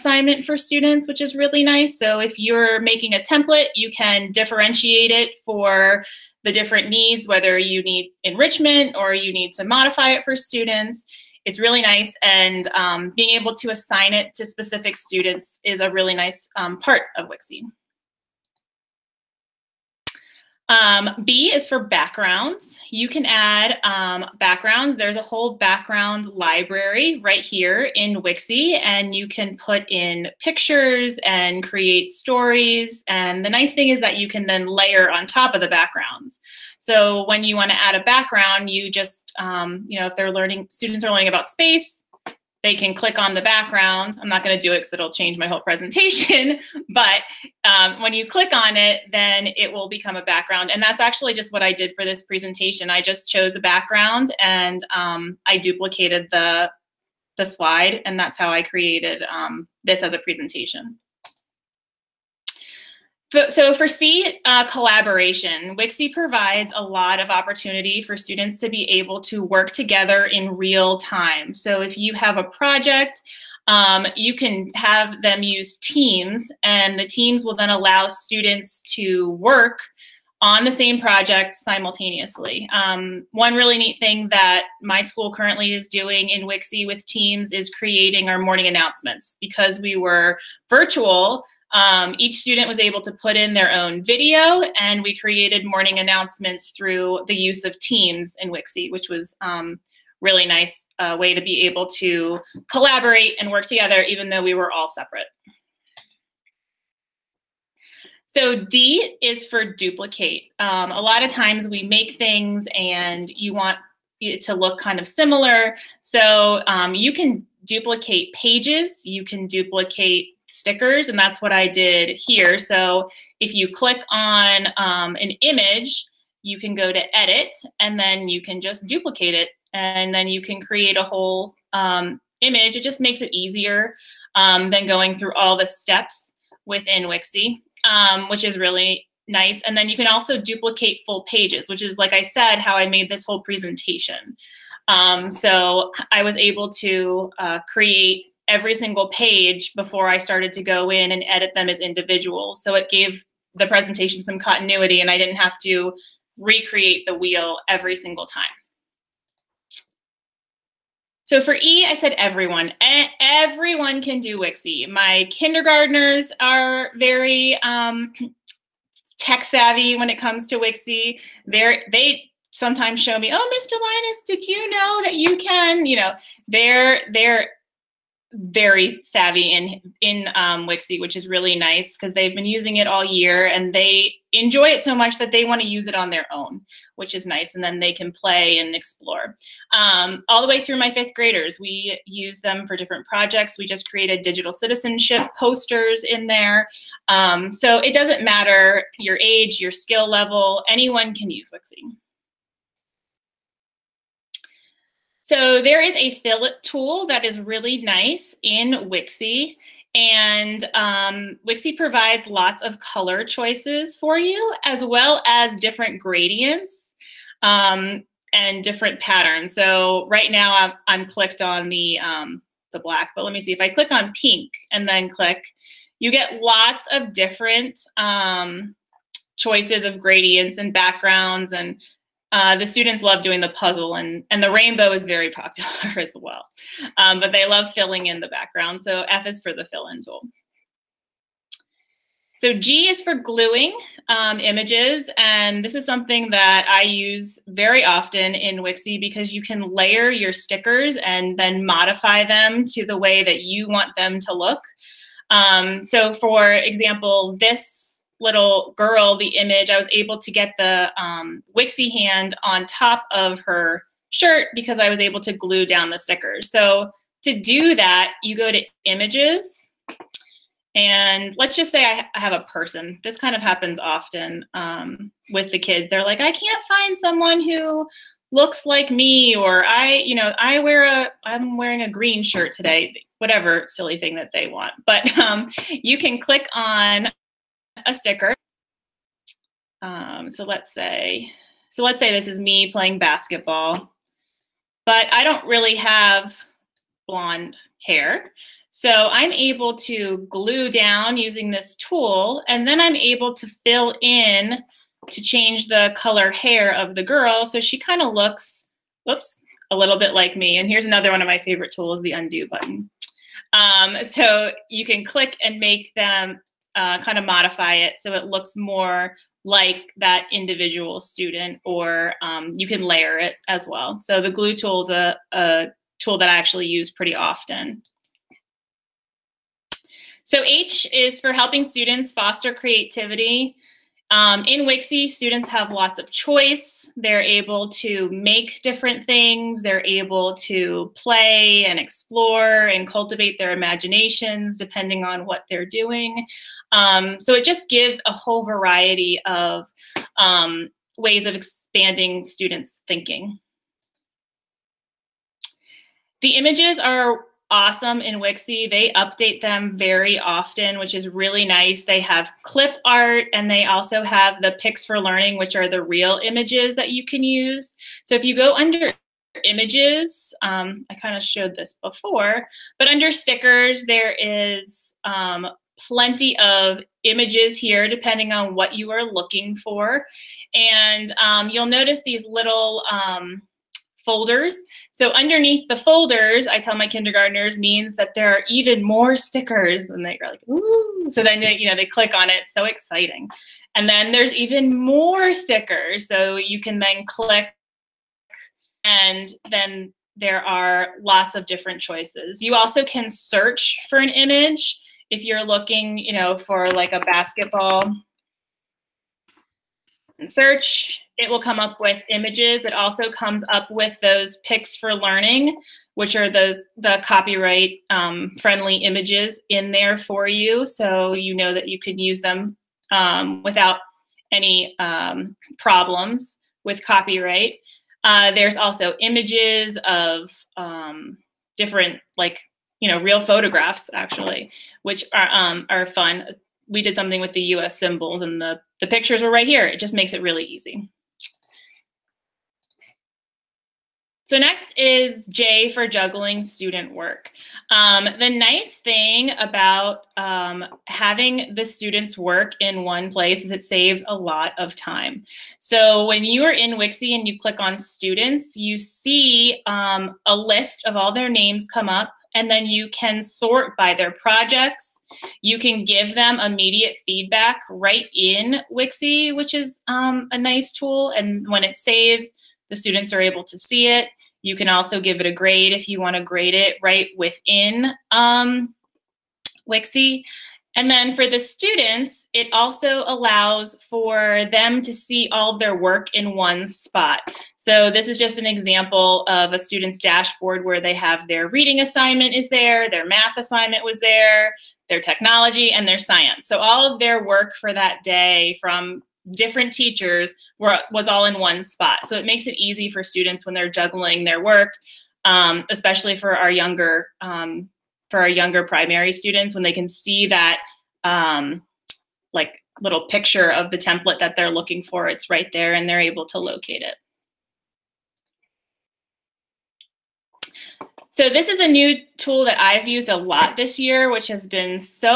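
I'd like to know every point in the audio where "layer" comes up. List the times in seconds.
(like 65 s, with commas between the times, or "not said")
34 s, 249 s, 322 s.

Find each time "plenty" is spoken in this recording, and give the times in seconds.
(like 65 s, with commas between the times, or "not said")
375 s.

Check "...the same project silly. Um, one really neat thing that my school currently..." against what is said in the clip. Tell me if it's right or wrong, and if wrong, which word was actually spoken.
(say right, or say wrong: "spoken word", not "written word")
wrong: "simultaneously", not "silly".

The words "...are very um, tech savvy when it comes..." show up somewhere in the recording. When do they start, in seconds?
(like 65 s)
166 s.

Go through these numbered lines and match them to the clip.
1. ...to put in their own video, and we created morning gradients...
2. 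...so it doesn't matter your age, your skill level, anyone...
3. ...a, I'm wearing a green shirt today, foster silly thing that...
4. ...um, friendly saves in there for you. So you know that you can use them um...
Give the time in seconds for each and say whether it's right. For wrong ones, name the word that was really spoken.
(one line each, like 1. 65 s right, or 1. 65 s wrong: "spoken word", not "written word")
1. 93 s wrong: "announcements", not "gradients"
2. 197 s right
3. 280 s wrong: "whatever", not "foster"
4. 417 s wrong: "images", not "saves".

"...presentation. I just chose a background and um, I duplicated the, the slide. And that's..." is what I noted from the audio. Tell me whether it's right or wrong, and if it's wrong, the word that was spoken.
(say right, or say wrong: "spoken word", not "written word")
right.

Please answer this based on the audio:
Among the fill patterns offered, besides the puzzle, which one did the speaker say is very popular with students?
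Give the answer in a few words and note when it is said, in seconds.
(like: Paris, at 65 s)
Rainbow, at 234 s.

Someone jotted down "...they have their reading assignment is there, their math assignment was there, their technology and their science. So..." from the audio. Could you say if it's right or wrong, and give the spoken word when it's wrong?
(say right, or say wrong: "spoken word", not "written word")
right.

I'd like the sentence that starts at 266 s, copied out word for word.
So to do that, you go to images and let's just say I, have a person.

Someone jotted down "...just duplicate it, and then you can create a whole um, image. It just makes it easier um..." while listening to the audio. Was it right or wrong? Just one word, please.
right.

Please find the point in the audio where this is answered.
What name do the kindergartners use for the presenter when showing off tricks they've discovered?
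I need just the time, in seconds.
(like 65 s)
173 s.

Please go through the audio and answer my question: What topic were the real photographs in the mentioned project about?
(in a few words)
US symbols.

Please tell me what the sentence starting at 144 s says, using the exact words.
Um, so I was able to uh, create every single page before I started to go in and edit them as individuals.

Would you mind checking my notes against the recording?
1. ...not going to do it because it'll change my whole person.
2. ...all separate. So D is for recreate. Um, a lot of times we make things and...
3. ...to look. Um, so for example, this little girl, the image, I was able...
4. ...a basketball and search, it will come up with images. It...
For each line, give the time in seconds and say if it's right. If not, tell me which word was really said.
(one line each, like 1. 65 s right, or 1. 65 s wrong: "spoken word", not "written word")
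1. 44 s wrong: "presentation", not "person"
2. 104 s wrong: "duplicate", not "recreate"
3. 254 s right
4. 406 s right.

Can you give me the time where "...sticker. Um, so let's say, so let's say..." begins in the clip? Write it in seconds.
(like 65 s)
287 s.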